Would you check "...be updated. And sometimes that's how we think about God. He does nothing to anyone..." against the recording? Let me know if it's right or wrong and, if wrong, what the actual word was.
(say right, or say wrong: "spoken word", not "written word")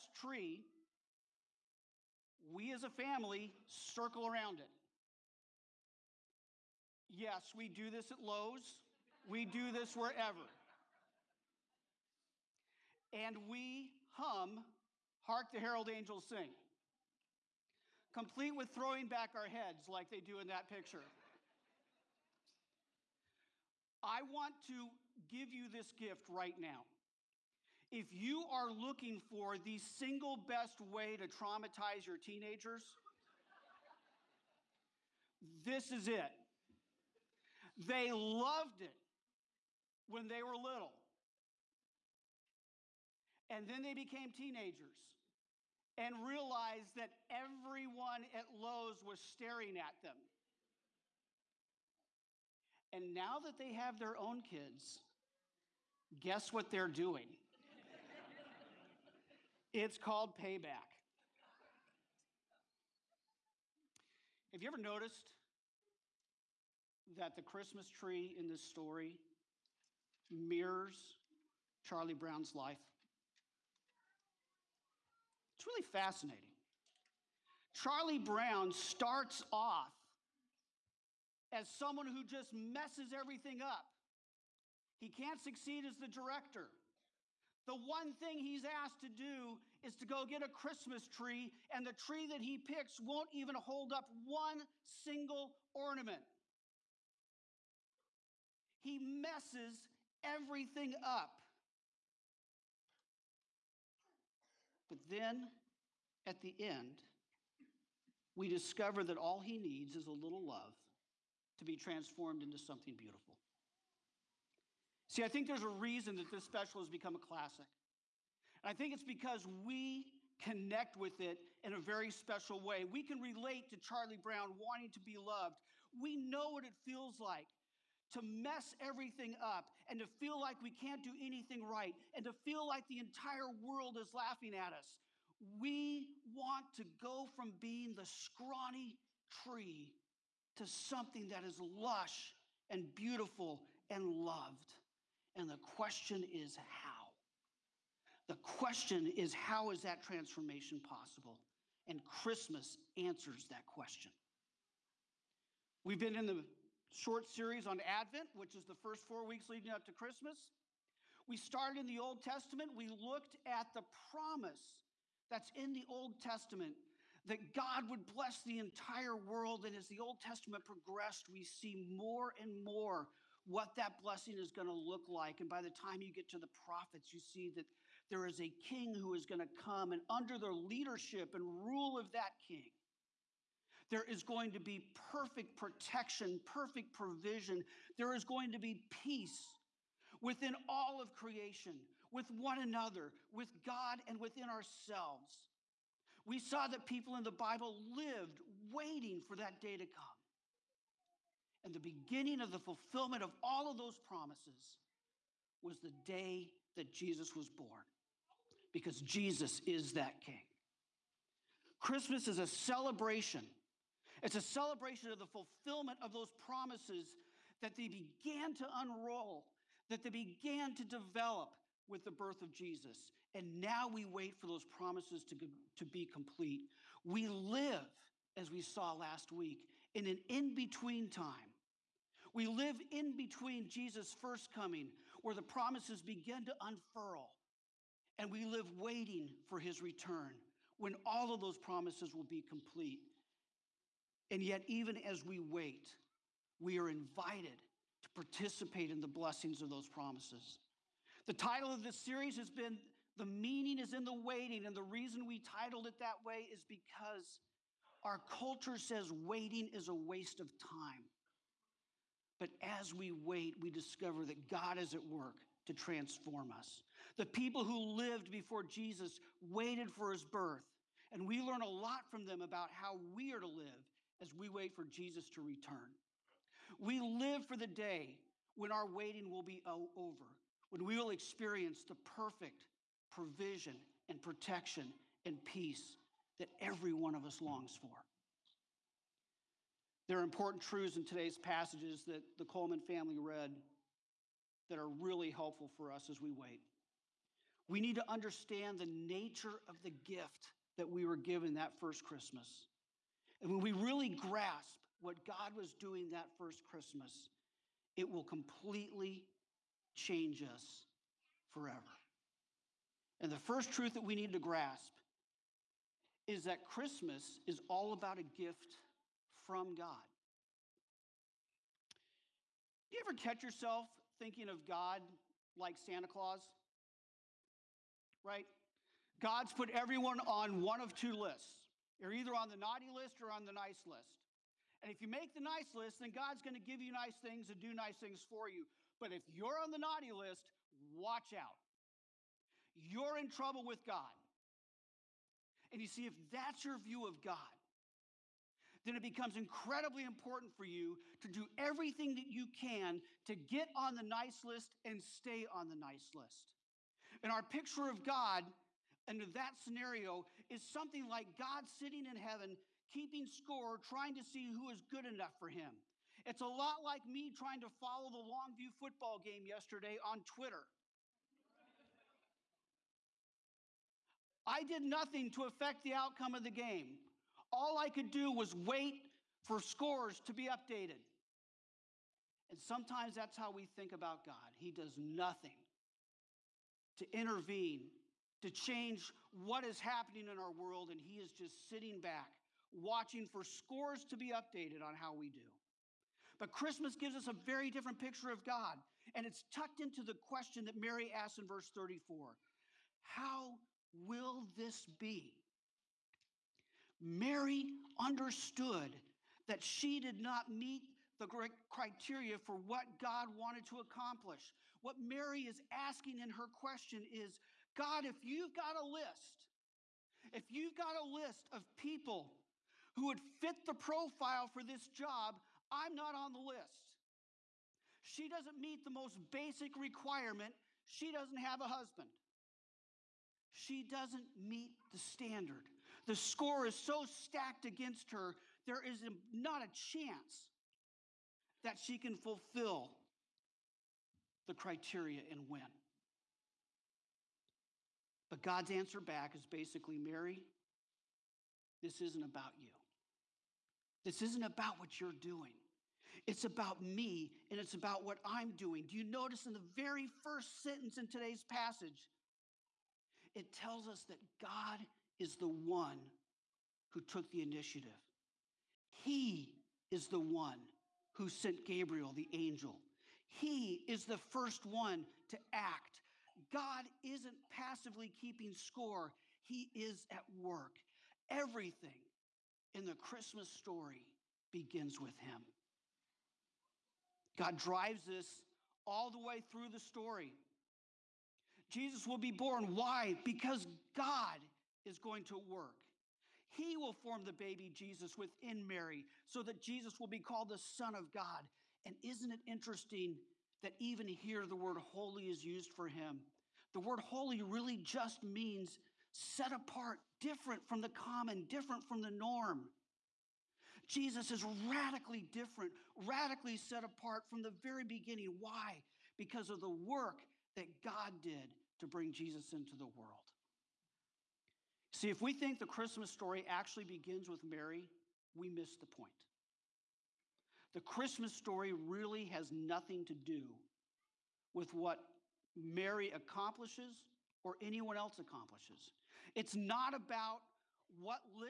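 wrong: "intervene", not "anyone".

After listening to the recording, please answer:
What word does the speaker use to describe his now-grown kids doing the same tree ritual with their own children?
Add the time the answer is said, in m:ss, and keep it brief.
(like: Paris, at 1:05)
payback, at 1:00.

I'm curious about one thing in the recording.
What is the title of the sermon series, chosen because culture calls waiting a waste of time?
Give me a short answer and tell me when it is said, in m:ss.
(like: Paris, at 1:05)
The Meaning is in the Waiting, at 4:13.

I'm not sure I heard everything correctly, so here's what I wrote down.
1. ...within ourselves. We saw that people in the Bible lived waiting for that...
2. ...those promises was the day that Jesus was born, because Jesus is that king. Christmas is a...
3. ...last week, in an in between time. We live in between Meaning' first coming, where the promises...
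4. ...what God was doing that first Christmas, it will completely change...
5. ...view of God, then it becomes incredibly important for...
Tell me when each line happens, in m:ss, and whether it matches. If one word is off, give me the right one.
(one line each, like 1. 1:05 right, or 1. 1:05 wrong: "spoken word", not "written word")
1. 3:14 right
2. 3:23 right
3. 3:48 wrong: "Jesus", not "Meaning"
4. 5:04 right
5. 5:46 right.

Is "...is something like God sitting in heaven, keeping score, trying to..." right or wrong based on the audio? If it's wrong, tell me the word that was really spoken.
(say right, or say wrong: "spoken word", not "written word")
right.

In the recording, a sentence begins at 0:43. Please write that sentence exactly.
And then they became teenagers and realized that everyone at Lowe's was staring at them.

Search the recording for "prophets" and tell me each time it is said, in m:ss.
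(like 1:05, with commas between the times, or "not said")
2:56.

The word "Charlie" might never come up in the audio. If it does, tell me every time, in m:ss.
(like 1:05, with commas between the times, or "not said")
1:11, 1:17, 2:03.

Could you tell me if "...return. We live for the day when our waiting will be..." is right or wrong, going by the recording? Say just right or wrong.
right.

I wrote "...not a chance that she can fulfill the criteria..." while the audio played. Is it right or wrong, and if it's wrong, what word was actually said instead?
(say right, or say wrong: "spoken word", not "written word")
right.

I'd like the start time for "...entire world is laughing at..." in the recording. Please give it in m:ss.
2:12.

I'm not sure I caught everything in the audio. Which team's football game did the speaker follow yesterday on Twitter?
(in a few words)
Longview.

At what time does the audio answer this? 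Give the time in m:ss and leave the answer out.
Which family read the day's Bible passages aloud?
4:52.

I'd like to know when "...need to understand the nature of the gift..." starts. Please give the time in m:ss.
4:57.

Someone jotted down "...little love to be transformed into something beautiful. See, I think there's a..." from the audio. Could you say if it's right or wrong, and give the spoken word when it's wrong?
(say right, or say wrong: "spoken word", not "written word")
right.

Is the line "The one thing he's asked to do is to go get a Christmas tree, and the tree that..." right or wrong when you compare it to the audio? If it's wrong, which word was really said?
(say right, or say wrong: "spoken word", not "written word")
right.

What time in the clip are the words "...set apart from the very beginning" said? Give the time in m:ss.
8:36.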